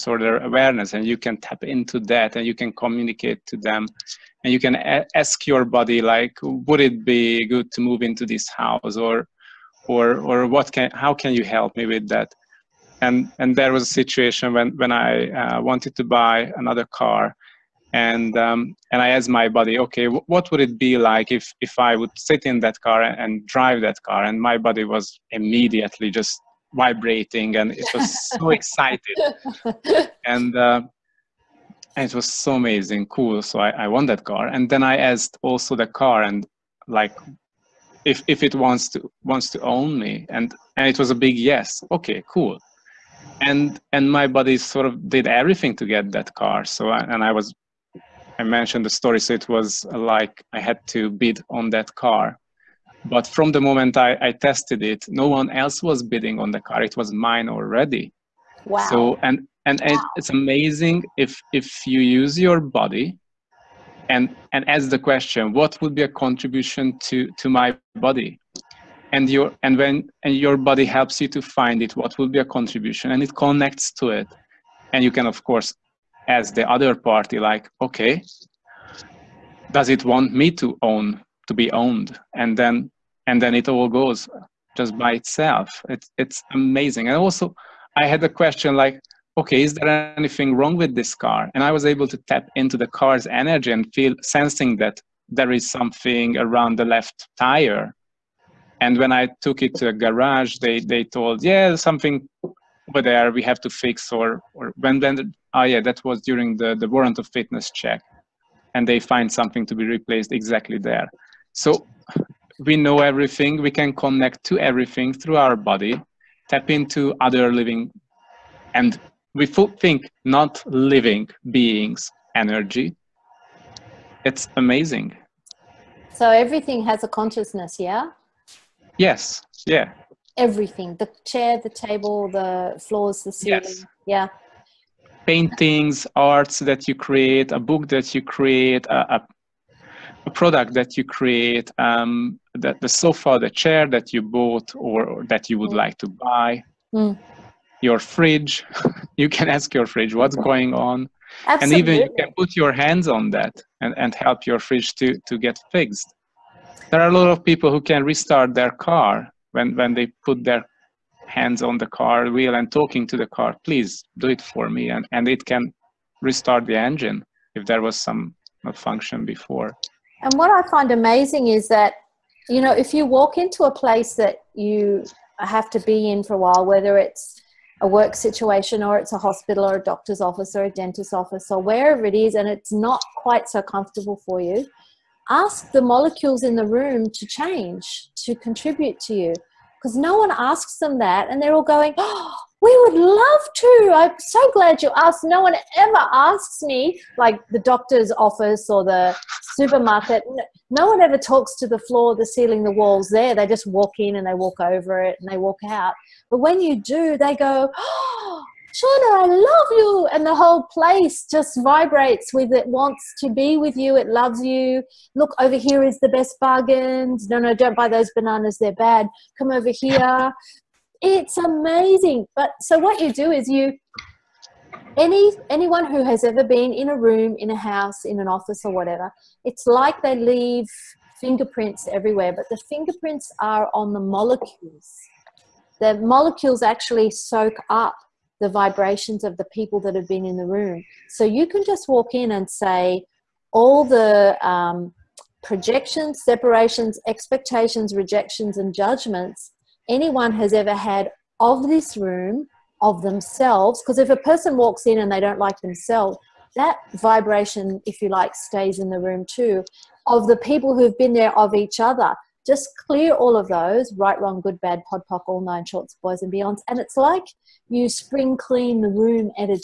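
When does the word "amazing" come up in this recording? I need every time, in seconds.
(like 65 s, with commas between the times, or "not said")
32 s, 60 s, 86 s, 124 s, 170 s, 221 s.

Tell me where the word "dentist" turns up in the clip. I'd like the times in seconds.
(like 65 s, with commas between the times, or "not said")
180 s.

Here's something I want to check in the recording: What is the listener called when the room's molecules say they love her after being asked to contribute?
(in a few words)
Shauna.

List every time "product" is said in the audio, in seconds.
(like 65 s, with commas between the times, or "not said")
140 s.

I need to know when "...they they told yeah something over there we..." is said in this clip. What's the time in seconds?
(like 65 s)
100 s.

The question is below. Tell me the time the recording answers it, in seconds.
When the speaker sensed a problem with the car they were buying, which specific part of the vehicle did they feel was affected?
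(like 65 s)
96 s.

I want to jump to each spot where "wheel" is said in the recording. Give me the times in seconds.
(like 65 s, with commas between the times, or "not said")
162 s.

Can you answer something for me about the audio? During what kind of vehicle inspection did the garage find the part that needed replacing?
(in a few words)
warrant of fitness check.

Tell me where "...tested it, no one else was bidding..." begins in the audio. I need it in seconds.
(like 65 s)
54 s.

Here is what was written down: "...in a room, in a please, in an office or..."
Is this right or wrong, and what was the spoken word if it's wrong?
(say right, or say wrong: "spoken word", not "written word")
wrong: "house", not "please".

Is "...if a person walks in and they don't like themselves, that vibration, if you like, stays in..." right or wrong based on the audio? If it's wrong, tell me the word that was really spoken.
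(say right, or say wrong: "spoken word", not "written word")
right.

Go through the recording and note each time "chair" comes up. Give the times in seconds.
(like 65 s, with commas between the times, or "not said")
131 s, 143 s.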